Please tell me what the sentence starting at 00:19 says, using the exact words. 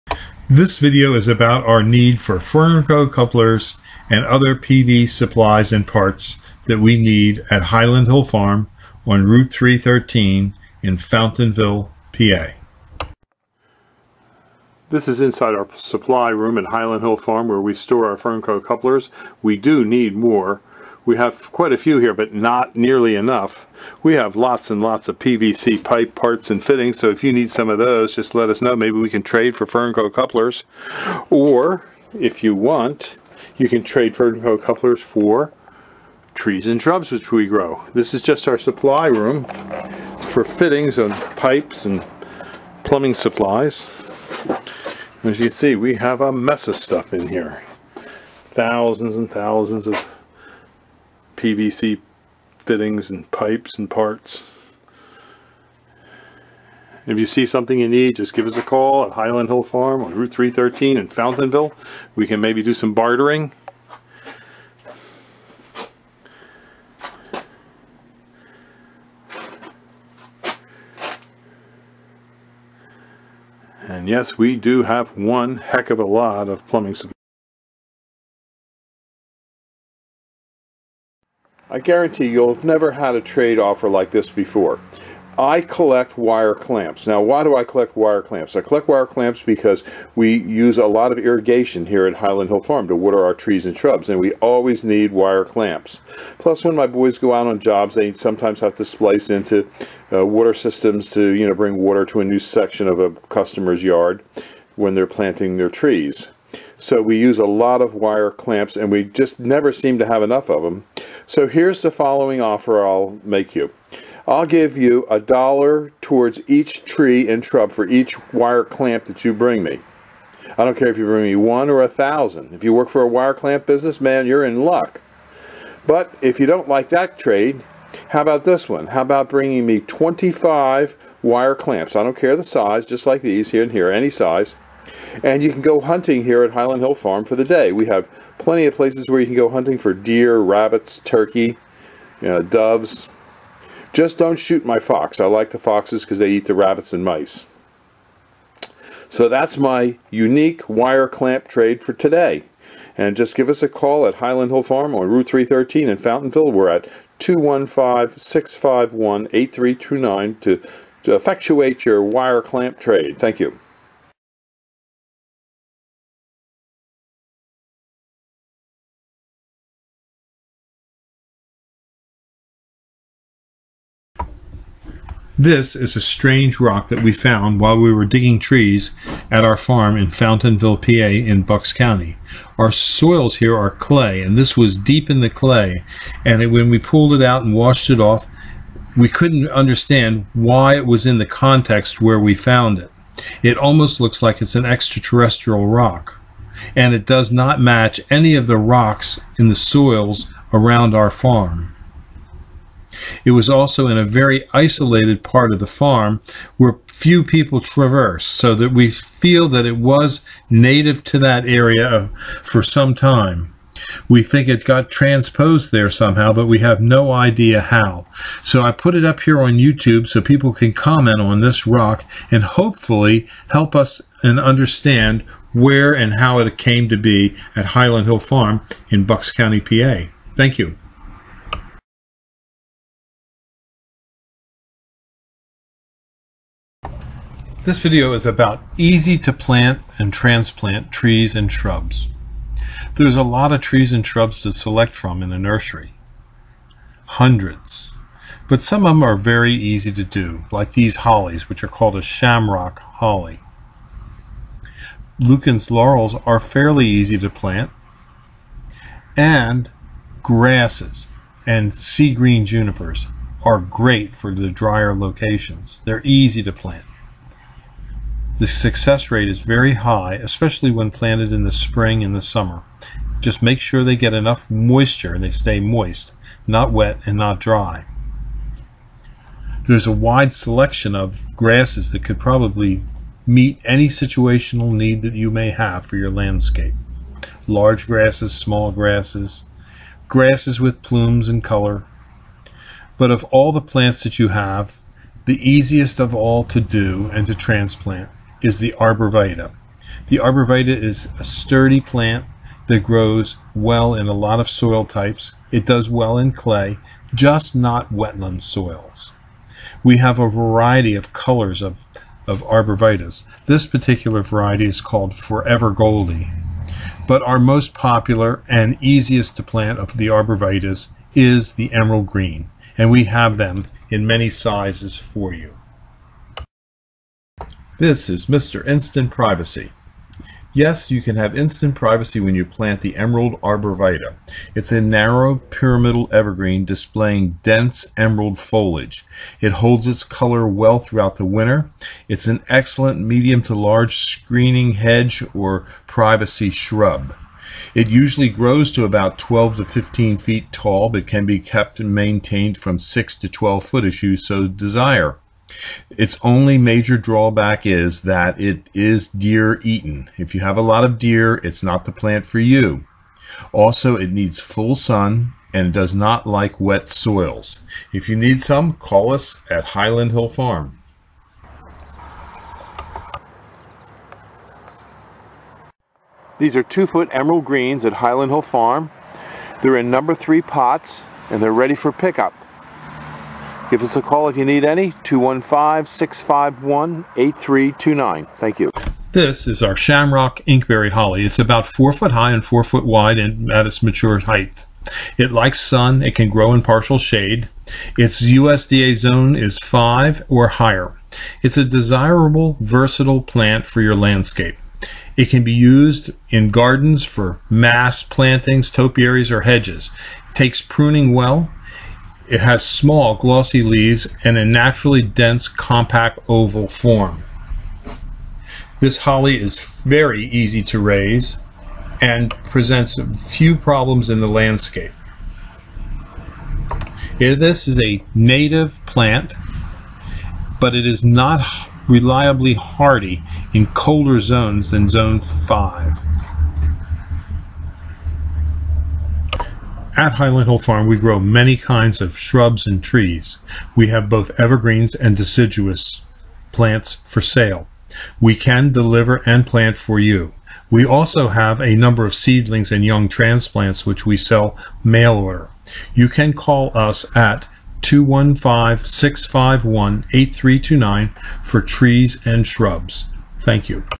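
We do need more we have quite a few here, but not nearly enough.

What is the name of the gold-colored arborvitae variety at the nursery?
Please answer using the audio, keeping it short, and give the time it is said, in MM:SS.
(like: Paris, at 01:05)
Forever Goldie, at 05:15.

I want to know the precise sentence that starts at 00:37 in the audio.
This is just our supply room for fittings and pipes and plumbing supplies.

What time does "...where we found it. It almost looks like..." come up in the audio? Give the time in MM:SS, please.
03:12.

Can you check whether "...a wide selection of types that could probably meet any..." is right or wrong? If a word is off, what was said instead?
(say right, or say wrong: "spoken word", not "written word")
wrong: "grasses", not "types".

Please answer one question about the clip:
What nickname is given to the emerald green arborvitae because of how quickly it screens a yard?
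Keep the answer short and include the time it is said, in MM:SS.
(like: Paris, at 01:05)
Mr. Instant Privacy, at 05:28.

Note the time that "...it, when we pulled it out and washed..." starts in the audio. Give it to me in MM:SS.
03:06.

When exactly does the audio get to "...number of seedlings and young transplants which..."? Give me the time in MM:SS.
07:31.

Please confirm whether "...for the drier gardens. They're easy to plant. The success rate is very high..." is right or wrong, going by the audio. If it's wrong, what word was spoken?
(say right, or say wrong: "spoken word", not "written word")
wrong: "locations", not "gardens".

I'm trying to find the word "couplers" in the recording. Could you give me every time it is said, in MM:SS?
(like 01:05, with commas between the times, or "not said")
00:03, 00:18, 00:30, 00:34.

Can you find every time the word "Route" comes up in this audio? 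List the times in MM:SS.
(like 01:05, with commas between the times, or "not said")
00:09, 01:00, 02:35.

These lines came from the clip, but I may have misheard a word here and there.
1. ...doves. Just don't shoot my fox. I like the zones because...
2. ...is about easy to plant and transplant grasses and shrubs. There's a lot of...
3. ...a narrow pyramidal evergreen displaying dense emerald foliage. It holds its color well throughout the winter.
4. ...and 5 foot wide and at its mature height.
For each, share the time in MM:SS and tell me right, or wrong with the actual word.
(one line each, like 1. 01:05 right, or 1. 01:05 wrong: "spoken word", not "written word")
1. 02:22 wrong: "foxes", not "zones"
2. 03:58 wrong: "trees", not "grasses"
3. 05:34 right
4. 06:32 wrong: "4", not "5".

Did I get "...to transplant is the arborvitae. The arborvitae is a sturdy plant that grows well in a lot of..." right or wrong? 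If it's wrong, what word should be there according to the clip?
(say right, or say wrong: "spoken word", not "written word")
right.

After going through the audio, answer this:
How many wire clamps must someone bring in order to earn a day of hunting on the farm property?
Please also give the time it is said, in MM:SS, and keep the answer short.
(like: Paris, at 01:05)
25, at 02:09.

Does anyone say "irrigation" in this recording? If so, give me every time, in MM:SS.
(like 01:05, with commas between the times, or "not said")
01:31.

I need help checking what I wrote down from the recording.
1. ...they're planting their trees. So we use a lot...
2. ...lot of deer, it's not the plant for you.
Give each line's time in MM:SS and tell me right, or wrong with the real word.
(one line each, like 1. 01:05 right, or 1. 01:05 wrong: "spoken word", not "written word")
1. 01:44 right
2. 06:00 right.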